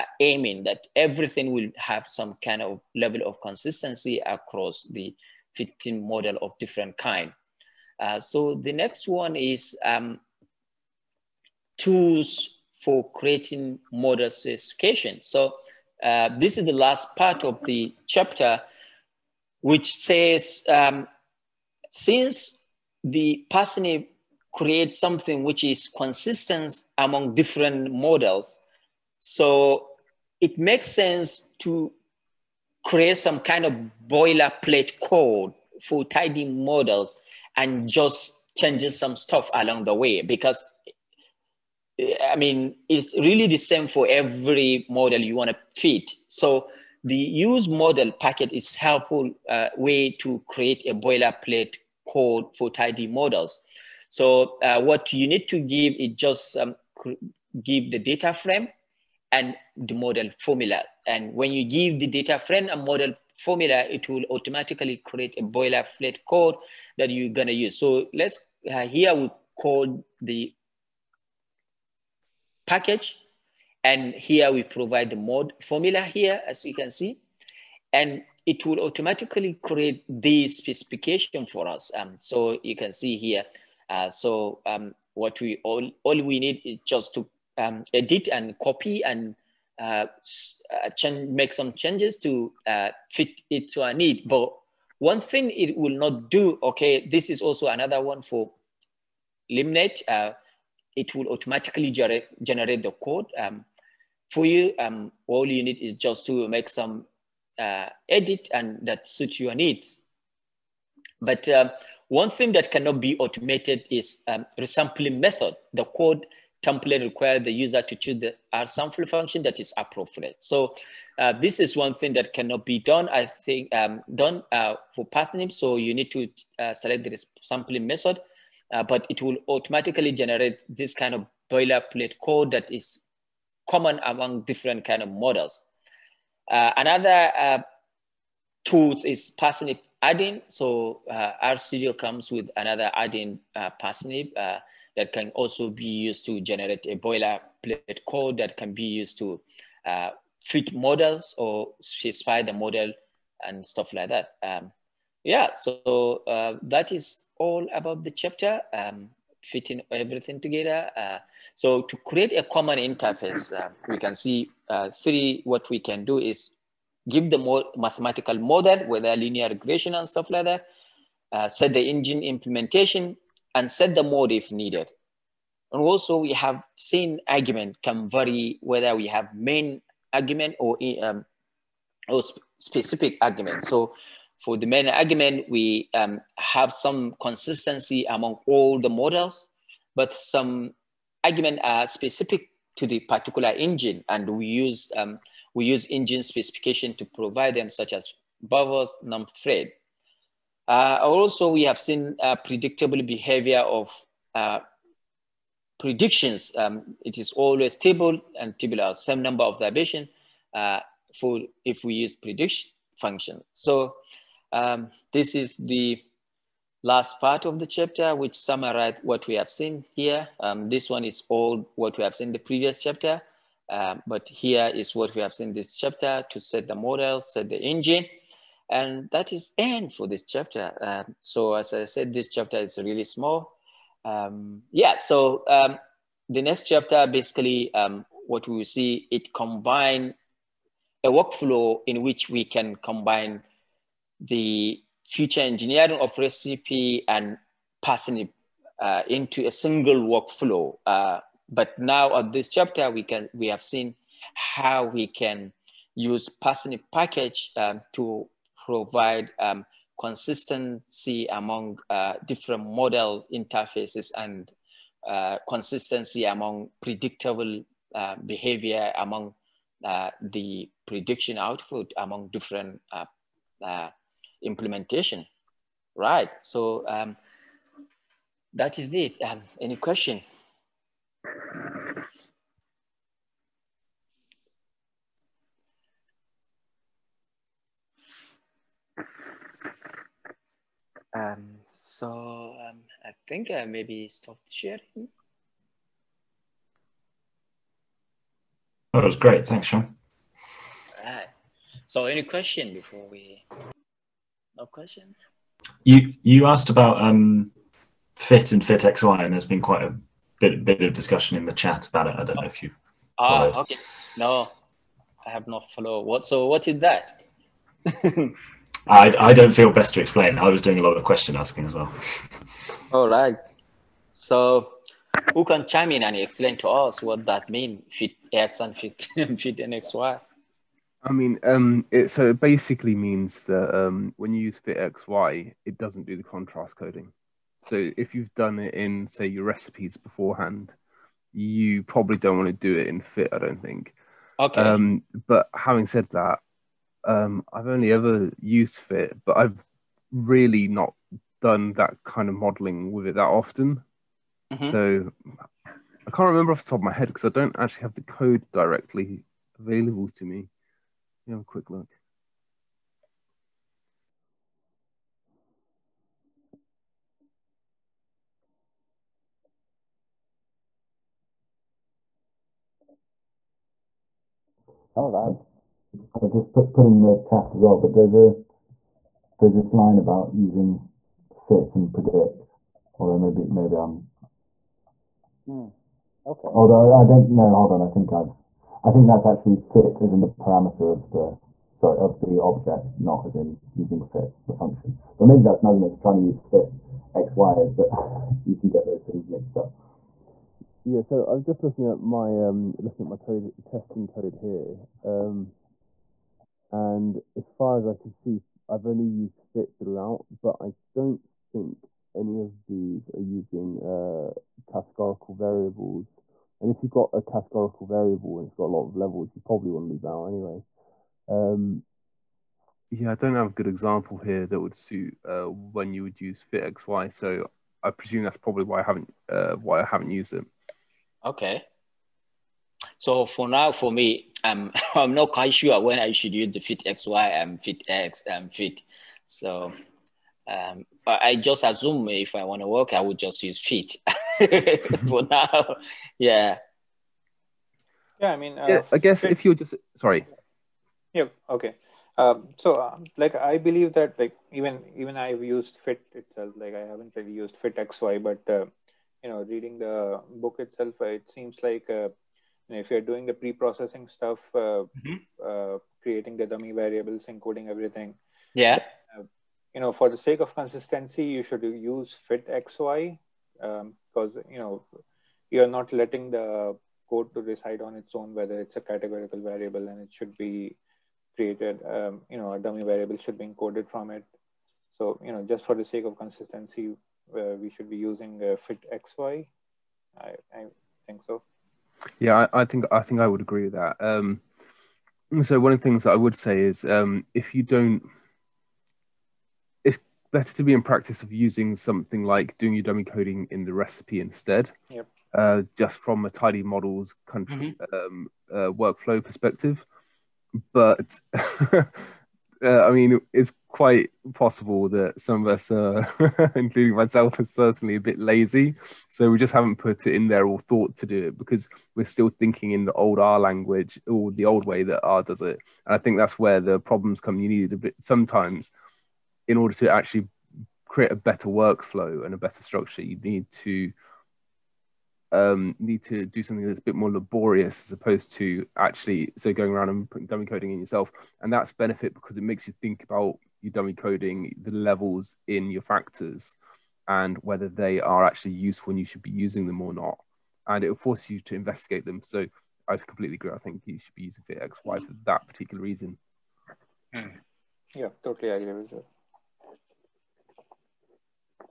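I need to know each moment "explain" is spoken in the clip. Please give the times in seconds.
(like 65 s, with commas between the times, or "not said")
319 s, 326 s.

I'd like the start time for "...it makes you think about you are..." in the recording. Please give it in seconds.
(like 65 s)
542 s.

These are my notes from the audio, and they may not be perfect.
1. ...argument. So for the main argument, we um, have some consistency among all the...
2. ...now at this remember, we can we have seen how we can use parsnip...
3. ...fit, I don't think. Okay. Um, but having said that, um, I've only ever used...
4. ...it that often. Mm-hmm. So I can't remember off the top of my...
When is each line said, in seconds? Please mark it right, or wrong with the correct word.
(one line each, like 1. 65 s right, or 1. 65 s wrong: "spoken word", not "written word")
1. 183 s right
2. 251 s wrong: "chapter", not "remember"
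3. 342 s right
4. 353 s right.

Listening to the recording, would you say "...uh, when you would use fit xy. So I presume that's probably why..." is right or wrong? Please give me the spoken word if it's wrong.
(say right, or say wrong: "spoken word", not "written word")
right.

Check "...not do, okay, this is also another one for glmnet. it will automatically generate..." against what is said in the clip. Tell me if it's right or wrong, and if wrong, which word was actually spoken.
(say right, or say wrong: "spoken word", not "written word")
right.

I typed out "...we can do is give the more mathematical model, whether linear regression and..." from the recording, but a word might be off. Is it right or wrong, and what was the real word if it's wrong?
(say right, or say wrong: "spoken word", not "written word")
right.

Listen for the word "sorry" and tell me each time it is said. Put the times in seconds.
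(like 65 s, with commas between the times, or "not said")
391 s, 449 s.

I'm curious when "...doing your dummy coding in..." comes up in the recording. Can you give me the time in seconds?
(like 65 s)
502 s.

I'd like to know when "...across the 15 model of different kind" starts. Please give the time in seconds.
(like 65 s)
4 s.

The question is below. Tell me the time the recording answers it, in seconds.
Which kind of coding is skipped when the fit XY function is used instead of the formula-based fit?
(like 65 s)
336 s.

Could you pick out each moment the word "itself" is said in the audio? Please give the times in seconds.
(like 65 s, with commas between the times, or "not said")
456 s, 460 s.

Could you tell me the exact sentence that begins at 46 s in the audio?
So the use model packet is helpful uh, way to create a boilerplate code for tidy models.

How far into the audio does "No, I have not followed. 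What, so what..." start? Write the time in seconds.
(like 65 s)
314 s.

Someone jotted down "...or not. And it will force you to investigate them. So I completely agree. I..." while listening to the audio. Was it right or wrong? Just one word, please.
right.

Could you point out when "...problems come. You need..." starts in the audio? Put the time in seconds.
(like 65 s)
526 s.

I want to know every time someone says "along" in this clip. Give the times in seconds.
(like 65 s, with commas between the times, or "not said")
39 s.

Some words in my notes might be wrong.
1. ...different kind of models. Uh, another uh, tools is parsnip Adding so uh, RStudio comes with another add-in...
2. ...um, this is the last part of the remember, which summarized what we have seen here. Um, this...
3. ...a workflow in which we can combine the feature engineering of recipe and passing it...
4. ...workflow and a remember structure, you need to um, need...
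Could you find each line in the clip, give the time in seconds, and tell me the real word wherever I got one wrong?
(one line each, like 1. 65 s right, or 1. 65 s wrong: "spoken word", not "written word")
1. 134 s right
2. 214 s wrong: "chapter", not "remember"
3. 241 s right
4. 531 s wrong: "better", not "remember".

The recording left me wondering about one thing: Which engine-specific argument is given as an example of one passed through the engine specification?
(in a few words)
verbose.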